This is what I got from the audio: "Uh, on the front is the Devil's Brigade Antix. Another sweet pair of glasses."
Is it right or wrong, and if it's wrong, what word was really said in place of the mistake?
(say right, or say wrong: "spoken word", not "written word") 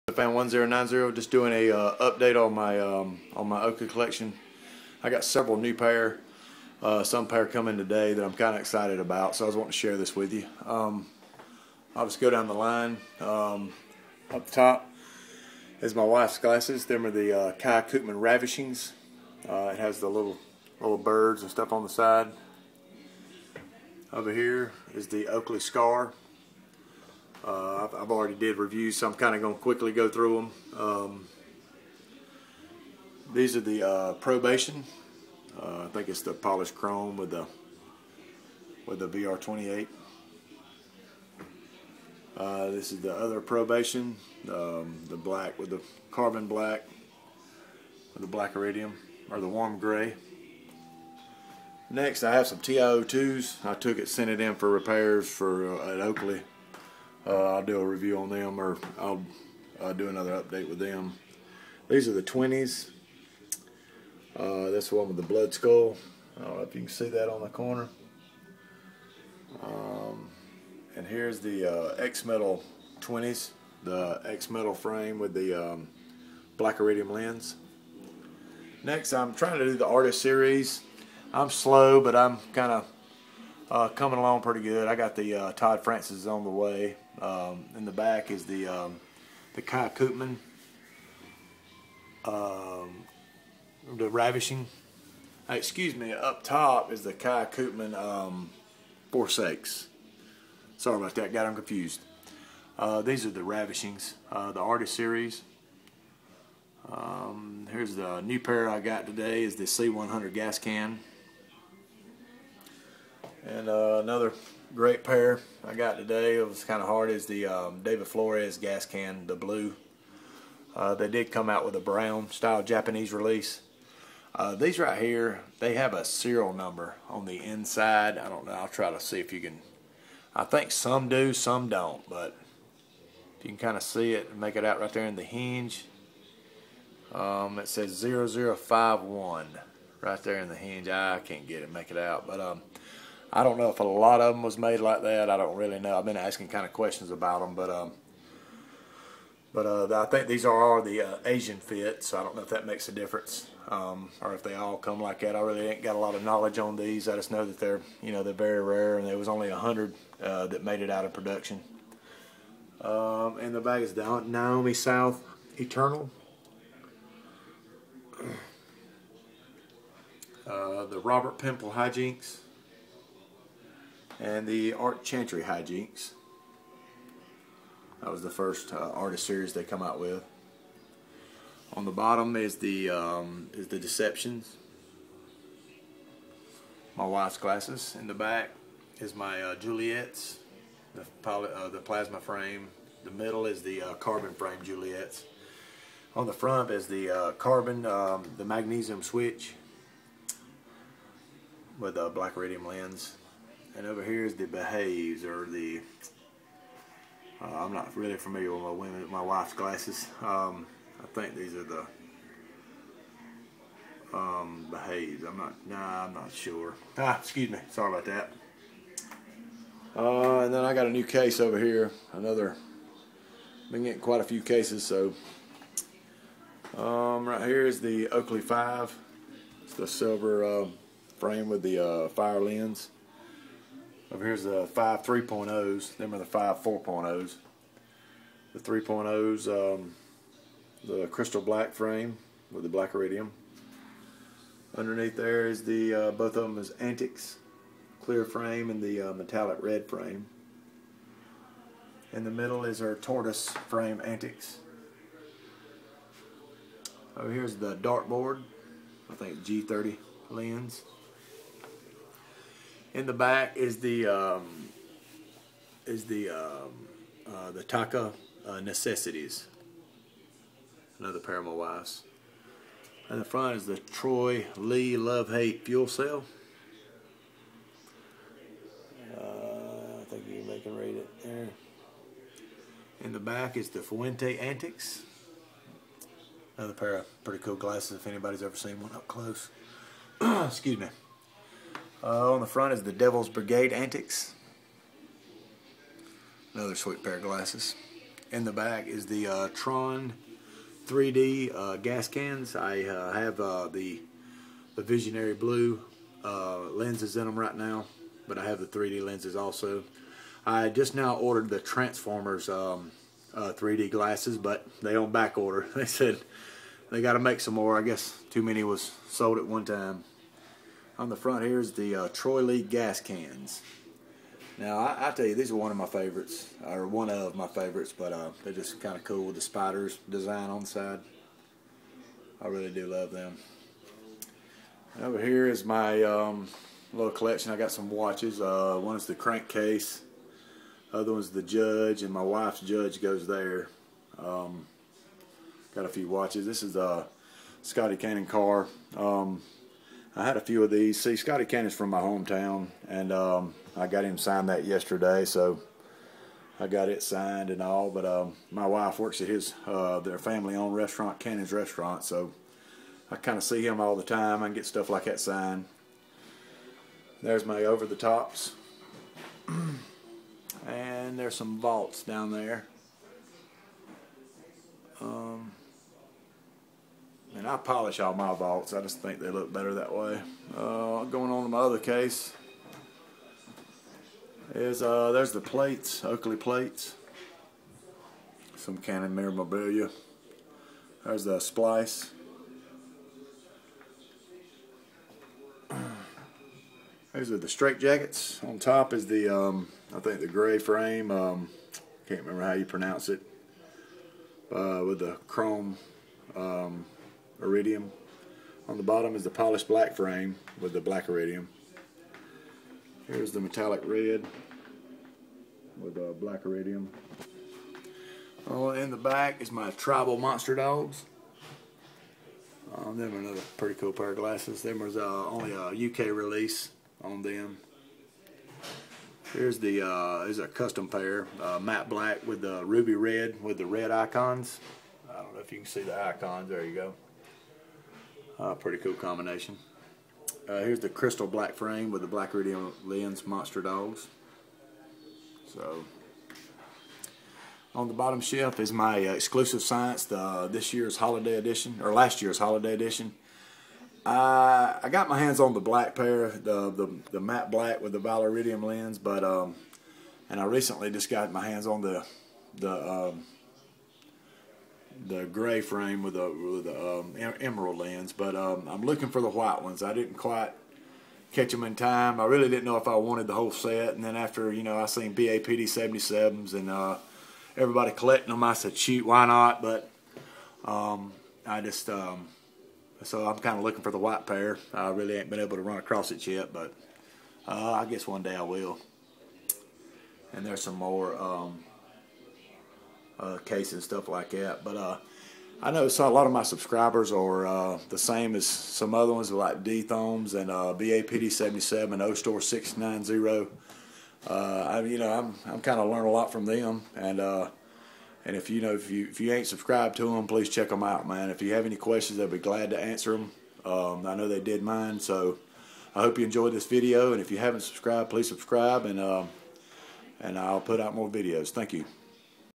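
right.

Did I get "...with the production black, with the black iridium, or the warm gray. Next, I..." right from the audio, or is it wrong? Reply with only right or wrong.
wrong.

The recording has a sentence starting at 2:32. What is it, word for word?
So I don't know if that makes a difference, um, or if they all come like that.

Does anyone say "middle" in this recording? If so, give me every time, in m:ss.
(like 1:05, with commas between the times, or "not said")
3:13, 4:12.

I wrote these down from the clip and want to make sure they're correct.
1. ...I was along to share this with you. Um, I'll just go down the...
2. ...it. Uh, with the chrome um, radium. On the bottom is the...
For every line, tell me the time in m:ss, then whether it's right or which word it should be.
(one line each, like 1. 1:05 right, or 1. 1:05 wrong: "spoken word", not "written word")
1. 0:09 wrong: "wanting", not "along"
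2. 6:43 wrong: "iridium", not "radium".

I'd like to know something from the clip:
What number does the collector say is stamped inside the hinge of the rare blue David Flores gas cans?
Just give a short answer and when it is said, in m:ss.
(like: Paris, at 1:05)
0051, at 2:18.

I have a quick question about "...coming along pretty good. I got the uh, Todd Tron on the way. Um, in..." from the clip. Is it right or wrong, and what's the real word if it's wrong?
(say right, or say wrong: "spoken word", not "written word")
wrong: "Francis", not "Tron".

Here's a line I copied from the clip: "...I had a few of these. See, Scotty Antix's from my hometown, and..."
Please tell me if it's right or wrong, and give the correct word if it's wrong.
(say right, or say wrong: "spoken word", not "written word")
wrong: "Cannon", not "Antix".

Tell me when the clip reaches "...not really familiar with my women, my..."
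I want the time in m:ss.
3:27.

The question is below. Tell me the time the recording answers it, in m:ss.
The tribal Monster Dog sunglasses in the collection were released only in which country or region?
7:05.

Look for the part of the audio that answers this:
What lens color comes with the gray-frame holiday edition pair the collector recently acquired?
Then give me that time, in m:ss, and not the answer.
7:47.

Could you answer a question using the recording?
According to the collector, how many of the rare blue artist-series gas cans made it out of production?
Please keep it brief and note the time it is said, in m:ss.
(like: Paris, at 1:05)
100, at 2:39.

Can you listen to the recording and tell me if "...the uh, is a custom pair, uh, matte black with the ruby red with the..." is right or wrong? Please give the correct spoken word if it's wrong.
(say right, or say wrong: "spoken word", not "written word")
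right.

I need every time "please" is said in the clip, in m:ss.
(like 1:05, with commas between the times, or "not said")
8:30, 8:38.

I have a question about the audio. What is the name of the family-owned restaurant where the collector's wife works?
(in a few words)
Cannon's Restaurant.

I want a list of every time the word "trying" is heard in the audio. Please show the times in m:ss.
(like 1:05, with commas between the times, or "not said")
1:19.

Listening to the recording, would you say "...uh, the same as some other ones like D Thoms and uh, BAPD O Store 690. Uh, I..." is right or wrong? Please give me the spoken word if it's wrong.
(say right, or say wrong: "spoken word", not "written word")
right.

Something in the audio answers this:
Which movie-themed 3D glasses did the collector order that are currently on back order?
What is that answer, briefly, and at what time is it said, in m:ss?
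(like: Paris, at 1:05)
Transformers, at 5:11.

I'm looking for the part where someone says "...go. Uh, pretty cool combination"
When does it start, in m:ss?
7:16.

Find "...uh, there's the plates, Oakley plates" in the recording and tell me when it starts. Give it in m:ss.
6:24.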